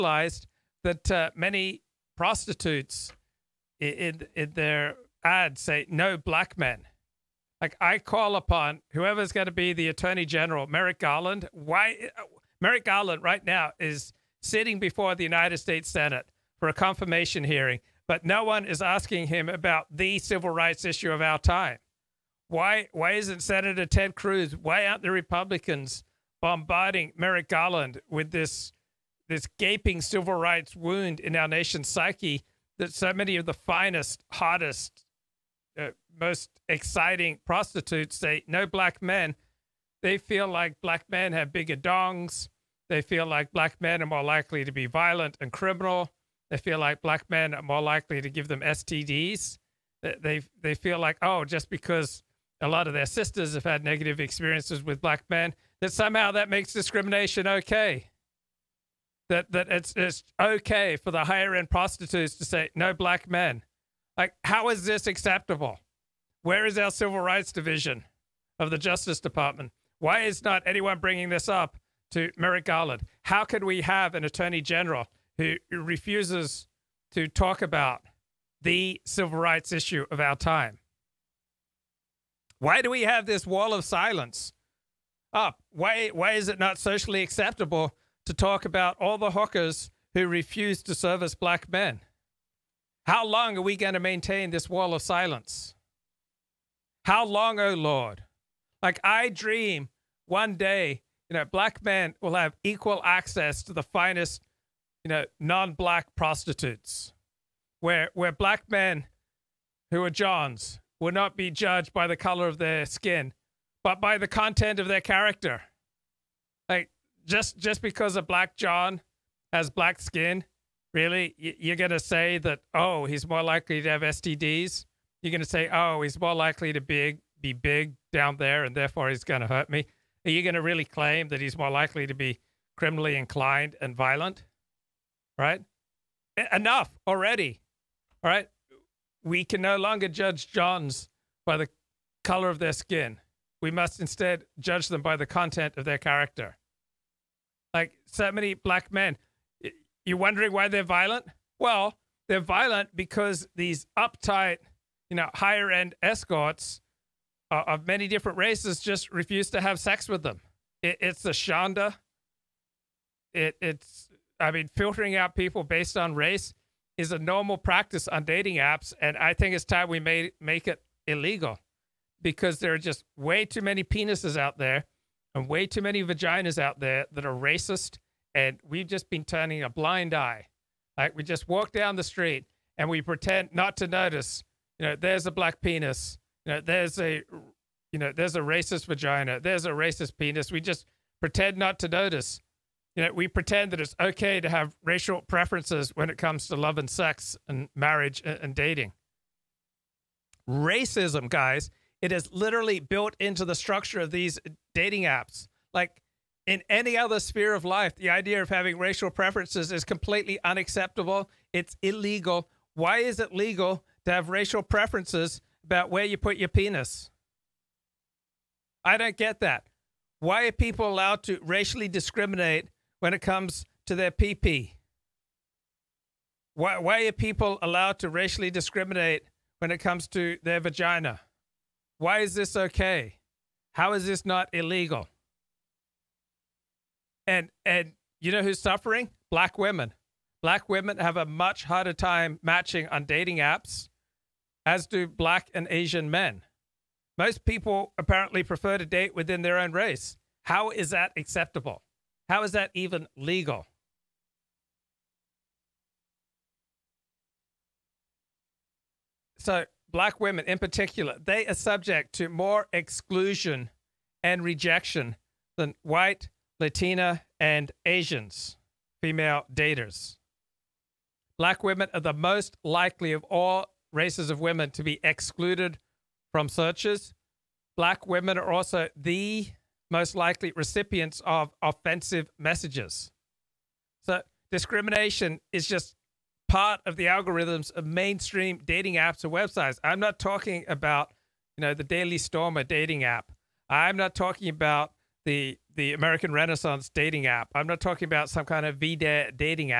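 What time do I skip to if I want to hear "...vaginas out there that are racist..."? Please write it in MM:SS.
02:56.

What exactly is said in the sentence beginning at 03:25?
Like in any other sphere of life, the idea of having racial preferences is completely unacceptable.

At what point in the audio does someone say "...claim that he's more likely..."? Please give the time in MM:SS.
02:10.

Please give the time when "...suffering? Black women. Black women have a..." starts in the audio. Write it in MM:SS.
03:58.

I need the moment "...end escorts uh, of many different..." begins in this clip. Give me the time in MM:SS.
02:35.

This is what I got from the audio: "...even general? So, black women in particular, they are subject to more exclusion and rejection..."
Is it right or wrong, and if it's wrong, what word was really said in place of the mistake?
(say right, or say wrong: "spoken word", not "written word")
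wrong: "legal", not "general".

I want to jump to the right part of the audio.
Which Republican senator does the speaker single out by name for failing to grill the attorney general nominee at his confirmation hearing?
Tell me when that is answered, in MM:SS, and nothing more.
00:23.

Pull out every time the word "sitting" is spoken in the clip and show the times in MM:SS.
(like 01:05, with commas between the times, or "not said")
00:14.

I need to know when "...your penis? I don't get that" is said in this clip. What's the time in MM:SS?
03:36.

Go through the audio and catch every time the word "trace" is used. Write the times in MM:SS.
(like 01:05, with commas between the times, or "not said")
not said.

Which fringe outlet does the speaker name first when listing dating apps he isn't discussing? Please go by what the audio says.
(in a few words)
Daily Stormer.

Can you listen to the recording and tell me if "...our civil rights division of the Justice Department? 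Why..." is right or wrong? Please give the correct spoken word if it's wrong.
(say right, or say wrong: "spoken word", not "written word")
right.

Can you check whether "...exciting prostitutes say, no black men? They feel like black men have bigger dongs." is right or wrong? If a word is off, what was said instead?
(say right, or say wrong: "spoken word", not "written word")
right.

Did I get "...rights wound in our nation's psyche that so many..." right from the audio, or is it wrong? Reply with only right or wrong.
right.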